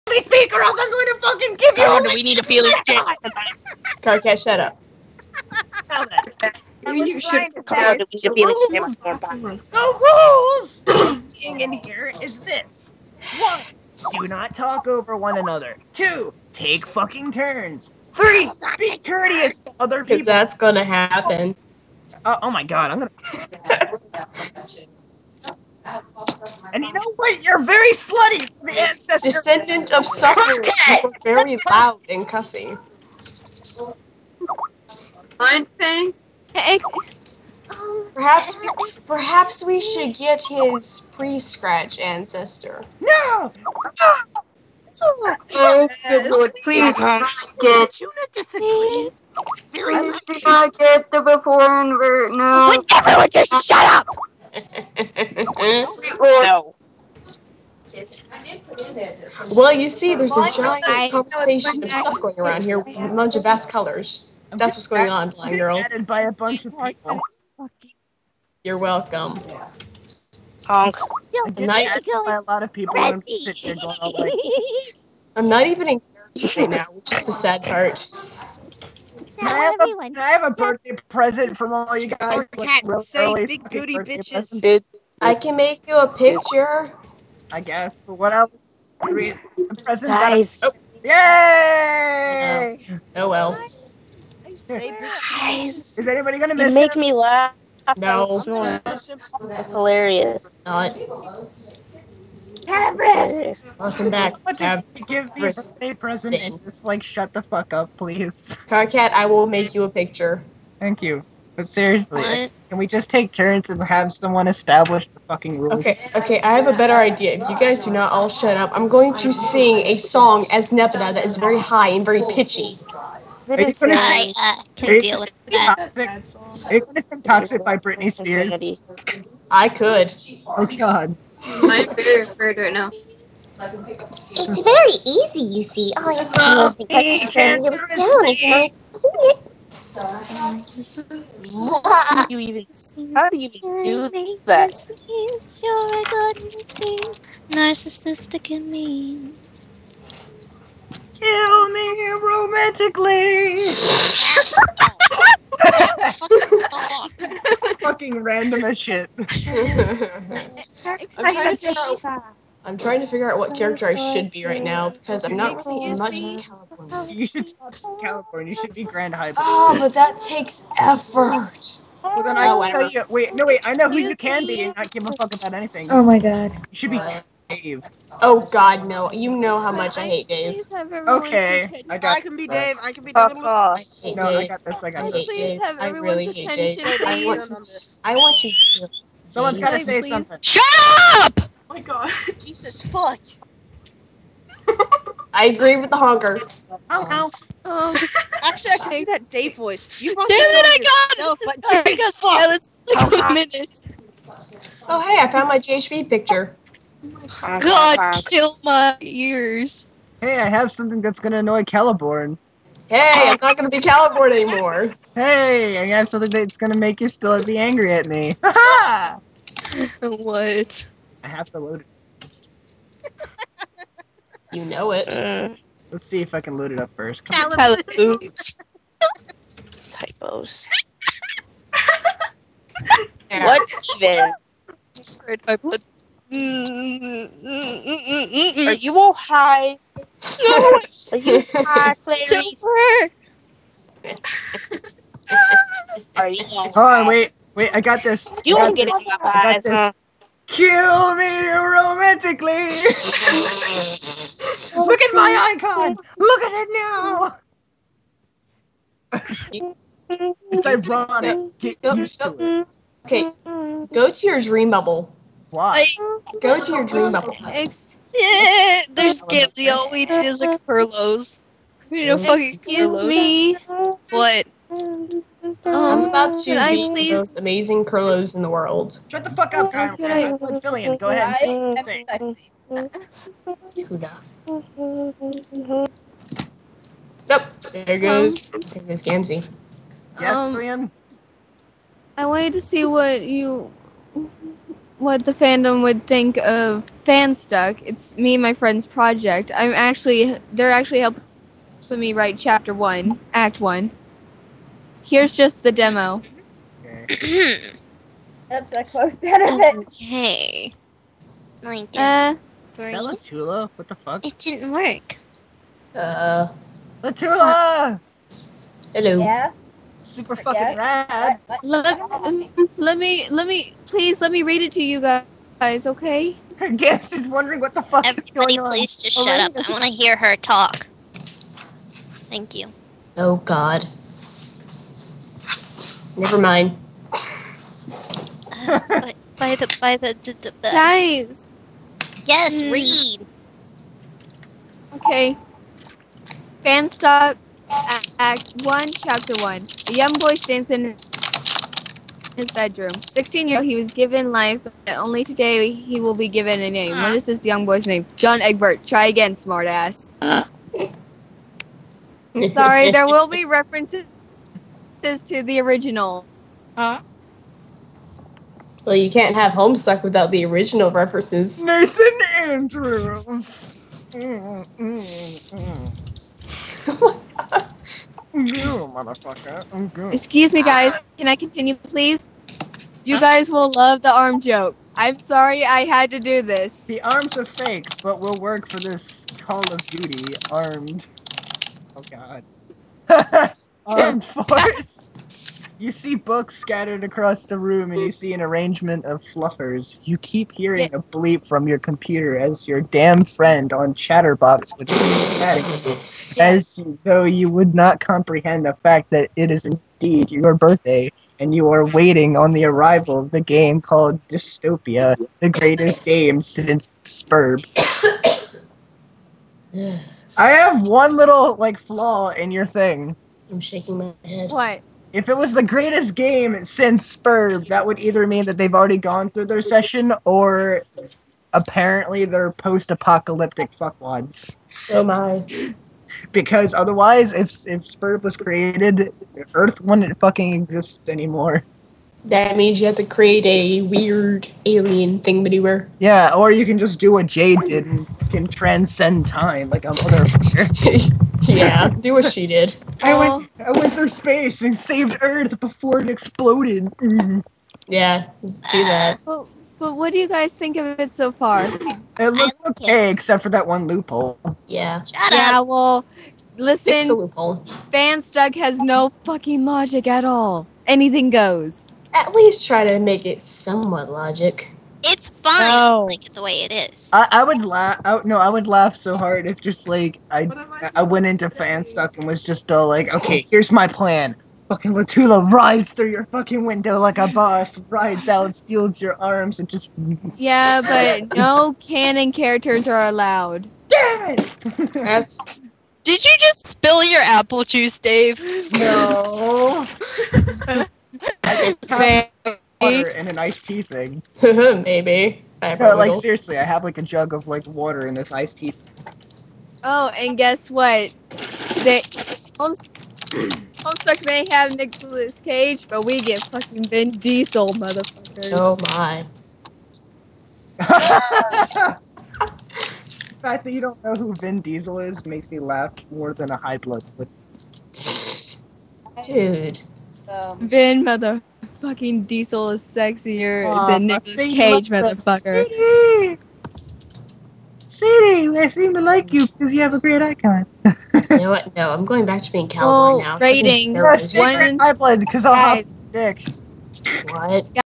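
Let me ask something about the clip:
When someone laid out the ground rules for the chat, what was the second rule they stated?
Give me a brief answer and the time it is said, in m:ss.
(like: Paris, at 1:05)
Take turns, at 0:16.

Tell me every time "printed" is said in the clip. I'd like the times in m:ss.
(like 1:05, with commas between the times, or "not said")
not said.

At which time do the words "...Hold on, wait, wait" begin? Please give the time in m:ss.
4:06.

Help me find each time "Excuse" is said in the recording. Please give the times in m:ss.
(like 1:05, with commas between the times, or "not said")
4:32, 6:20.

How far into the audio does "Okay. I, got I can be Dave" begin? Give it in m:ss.
3:01.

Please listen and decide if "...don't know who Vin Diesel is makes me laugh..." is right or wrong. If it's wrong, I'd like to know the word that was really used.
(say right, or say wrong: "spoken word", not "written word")
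right.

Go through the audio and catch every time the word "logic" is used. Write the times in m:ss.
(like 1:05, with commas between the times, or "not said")
7:49, 7:54.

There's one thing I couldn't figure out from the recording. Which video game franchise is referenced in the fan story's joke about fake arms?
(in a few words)
Call of Duty.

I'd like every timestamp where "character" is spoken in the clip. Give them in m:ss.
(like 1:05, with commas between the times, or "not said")
1:16, 2:43, 8:12.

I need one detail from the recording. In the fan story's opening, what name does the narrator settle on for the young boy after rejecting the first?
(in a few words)
Nathan Andrews.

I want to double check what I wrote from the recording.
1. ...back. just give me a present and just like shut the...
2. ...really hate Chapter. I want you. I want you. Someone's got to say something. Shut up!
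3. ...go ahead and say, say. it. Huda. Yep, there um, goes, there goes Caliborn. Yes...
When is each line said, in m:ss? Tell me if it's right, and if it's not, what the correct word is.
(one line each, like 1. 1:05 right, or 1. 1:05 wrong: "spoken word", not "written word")
1. 1:44 right
2. 3:05 wrong: "Dave", not "Chapter"
3. 4:40 wrong: "Gamzee", not "Caliborn".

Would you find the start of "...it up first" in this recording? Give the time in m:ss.
3:46.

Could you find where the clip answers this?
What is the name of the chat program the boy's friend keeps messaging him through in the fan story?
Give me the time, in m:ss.
6:43.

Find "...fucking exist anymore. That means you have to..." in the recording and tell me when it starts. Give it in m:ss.
7:20.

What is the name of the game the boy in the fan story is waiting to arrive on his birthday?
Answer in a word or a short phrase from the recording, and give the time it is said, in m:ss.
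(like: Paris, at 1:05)
Dystopia, at 6:54.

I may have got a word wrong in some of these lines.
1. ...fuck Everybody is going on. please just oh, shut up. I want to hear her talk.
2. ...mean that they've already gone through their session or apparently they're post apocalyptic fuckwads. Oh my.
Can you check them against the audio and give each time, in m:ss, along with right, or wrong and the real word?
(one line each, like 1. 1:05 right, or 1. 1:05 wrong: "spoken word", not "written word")
1. 5:27 right
2. 7:08 right.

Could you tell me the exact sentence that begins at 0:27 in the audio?
You're very slutty for the ancestor.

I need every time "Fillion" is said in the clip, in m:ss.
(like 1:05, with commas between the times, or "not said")
4:40, 4:50.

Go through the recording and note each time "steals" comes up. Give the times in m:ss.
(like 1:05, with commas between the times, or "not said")
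8:08.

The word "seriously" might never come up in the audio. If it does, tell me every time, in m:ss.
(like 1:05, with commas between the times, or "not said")
1:51, 8:26.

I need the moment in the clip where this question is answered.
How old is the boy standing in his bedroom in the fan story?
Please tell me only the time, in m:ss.
5:53.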